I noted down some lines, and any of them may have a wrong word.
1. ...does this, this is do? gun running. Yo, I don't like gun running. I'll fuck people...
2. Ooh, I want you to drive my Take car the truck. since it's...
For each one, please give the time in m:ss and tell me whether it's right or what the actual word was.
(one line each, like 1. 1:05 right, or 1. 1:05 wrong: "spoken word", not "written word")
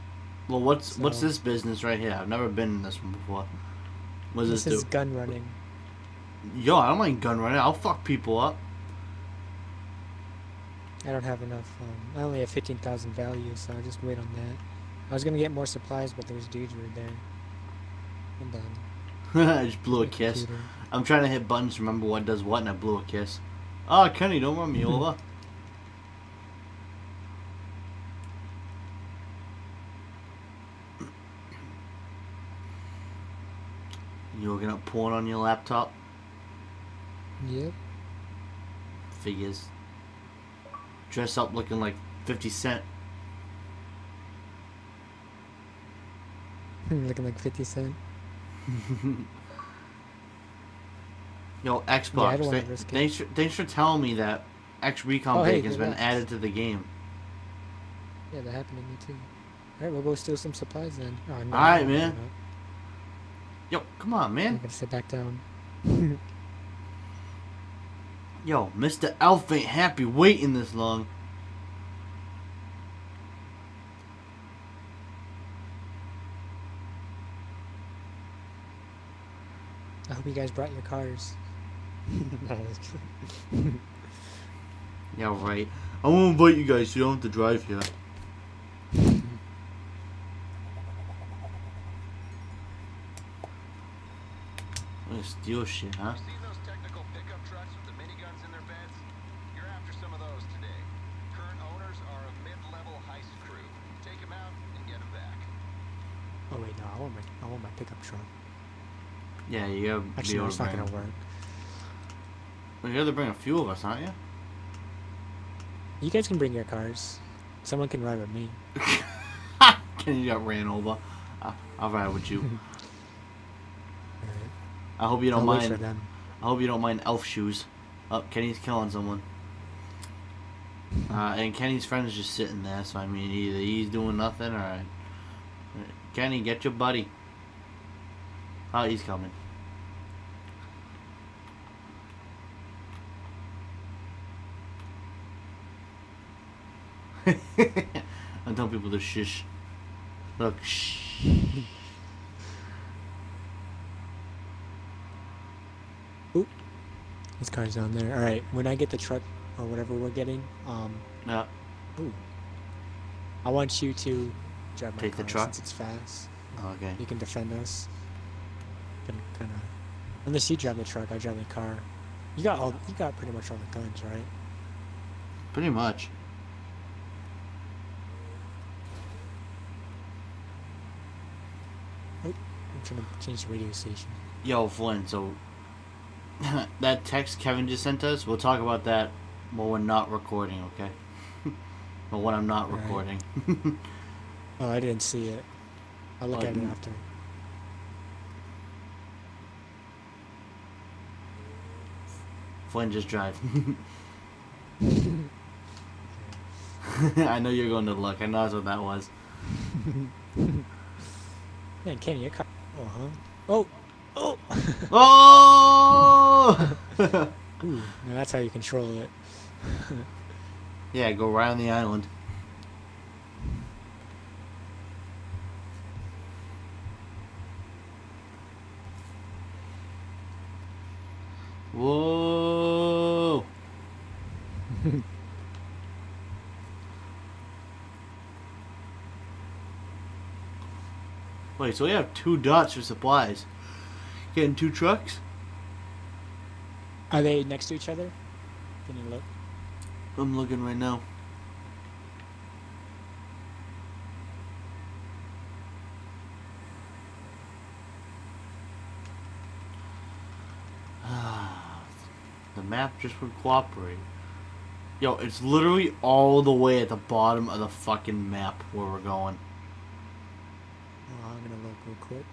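1. 0:04 right
2. 2:41 right.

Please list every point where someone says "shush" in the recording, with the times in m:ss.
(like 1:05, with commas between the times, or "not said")
2:28.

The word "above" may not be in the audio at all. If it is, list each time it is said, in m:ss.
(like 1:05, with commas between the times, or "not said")
not said.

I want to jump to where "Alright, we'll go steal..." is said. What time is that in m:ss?
0:59.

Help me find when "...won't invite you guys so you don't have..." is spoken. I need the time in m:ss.
1:26.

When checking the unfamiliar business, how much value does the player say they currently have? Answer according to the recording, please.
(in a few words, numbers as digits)
15,000.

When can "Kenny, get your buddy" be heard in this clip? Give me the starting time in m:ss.
2:16.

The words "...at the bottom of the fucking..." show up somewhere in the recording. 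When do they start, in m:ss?
4:26.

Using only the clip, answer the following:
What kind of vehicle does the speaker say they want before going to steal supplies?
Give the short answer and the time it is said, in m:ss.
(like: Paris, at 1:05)
pickup truck, at 1:47.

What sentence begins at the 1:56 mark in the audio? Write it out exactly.
You guys can bring your cars.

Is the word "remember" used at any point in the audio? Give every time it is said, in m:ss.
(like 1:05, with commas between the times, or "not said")
0:21.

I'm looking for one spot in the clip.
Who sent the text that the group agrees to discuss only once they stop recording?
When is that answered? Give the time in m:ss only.
3:07.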